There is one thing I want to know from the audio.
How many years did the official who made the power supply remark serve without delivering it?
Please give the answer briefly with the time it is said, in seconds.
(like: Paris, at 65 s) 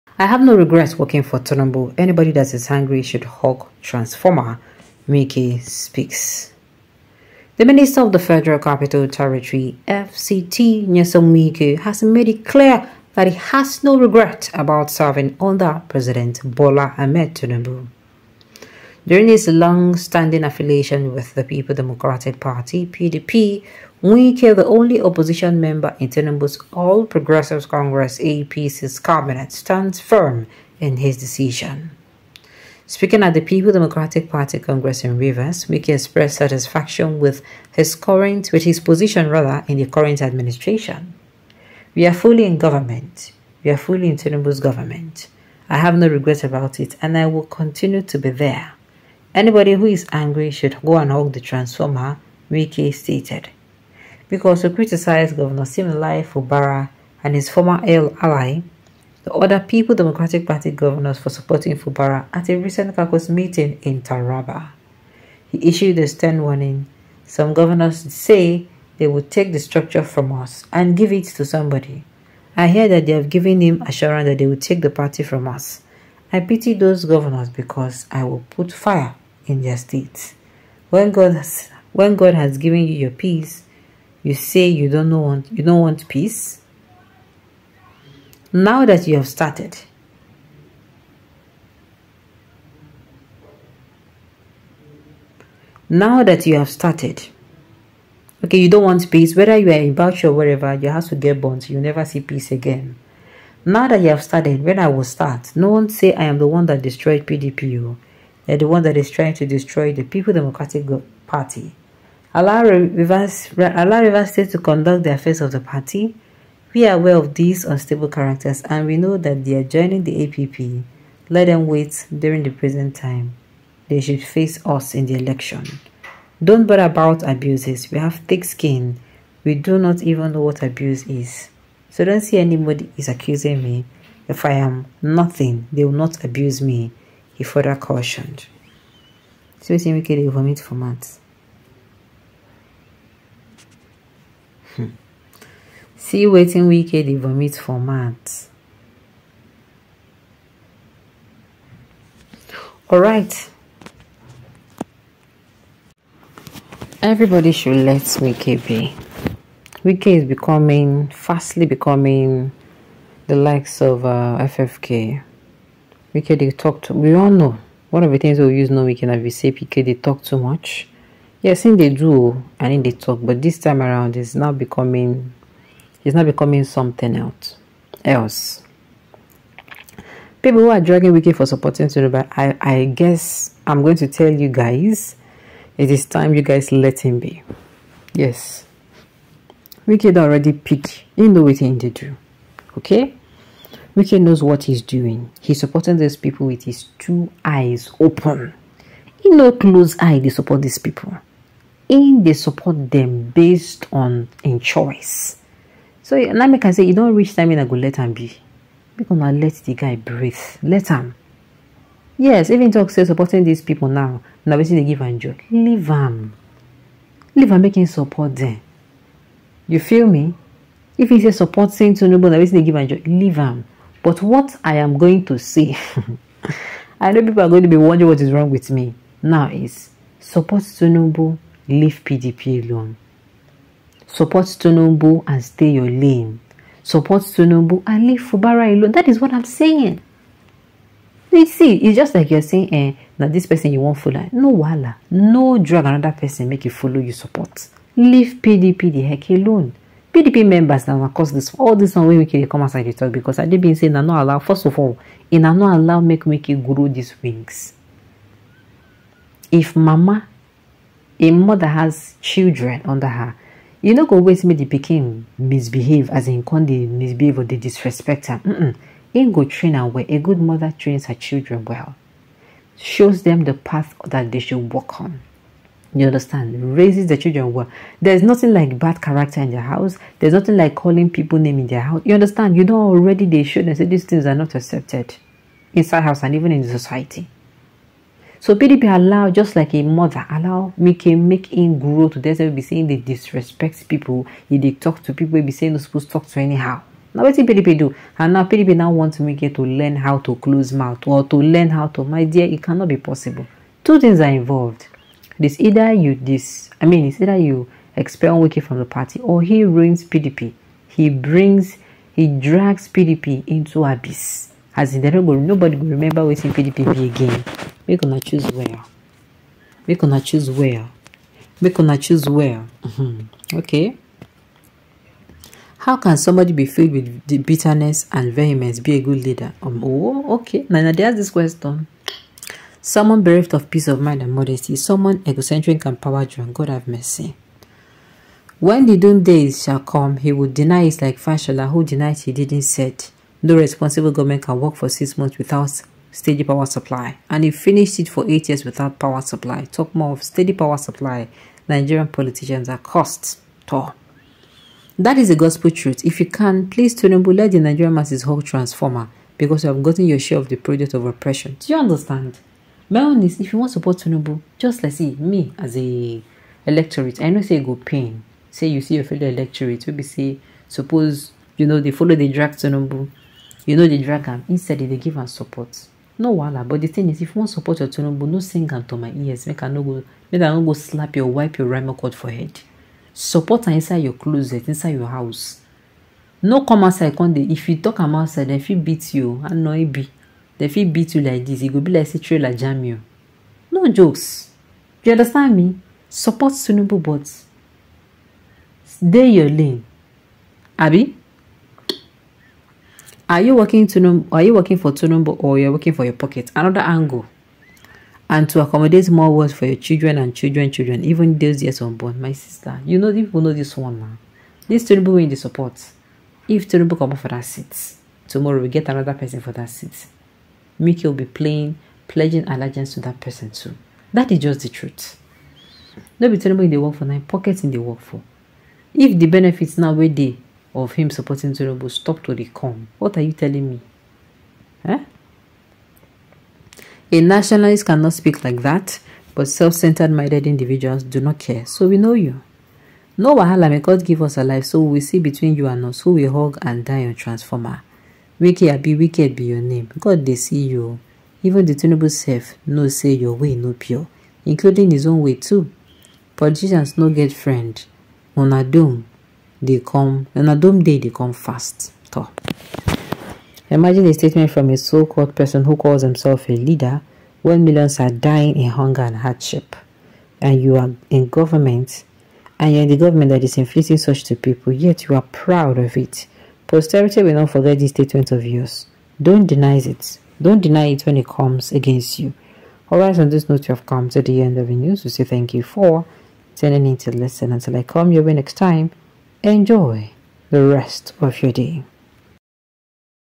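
8, at 348 s.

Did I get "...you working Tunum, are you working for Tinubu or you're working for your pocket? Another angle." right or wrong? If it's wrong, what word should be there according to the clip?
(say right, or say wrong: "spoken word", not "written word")
right.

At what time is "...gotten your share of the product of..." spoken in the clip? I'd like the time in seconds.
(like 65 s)
359 s.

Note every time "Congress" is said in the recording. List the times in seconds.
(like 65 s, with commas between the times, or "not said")
27 s, 34 s.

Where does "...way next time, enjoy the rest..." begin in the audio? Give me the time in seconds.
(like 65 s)
488 s.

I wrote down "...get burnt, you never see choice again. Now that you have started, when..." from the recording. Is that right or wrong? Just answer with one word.
wrong.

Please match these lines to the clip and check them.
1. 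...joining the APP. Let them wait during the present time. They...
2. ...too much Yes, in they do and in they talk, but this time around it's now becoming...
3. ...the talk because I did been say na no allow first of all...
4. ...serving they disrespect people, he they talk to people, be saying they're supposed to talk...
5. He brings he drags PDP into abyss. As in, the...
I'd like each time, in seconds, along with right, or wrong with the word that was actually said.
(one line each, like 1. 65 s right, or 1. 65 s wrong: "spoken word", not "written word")
1. 119 s right
2. 170 s right
3. 252 s right
4. 292 s wrong: "saying", not "serving"
5. 310 s right.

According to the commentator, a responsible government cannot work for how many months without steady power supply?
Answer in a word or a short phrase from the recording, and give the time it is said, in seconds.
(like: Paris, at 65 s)
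6, at 344 s.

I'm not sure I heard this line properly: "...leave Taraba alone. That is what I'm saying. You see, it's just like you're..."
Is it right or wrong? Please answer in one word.
wrong.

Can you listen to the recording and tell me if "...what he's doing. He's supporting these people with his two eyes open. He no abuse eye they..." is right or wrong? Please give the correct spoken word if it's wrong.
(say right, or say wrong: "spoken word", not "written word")
wrong: "close", not "abuse".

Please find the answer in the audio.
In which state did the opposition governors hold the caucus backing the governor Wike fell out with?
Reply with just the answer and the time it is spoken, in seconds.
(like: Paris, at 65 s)
Taraba, at 64 s.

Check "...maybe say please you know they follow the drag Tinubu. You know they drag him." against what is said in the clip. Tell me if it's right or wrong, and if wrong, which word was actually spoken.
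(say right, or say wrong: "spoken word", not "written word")
wrong: "suppose", not "please".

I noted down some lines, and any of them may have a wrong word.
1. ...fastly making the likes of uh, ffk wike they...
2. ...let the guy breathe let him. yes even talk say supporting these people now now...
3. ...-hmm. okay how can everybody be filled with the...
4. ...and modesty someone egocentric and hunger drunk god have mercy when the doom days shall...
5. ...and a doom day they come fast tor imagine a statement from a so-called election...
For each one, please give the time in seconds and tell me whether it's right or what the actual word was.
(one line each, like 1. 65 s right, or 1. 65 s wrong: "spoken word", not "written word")
1. 161 s wrong: "becoming", not "making"
2. 209 s right
3. 322 s wrong: "somebody", not "everybody"
4. 334 s wrong: "power", not "hunger"
5. 460 s wrong: "person", not "election".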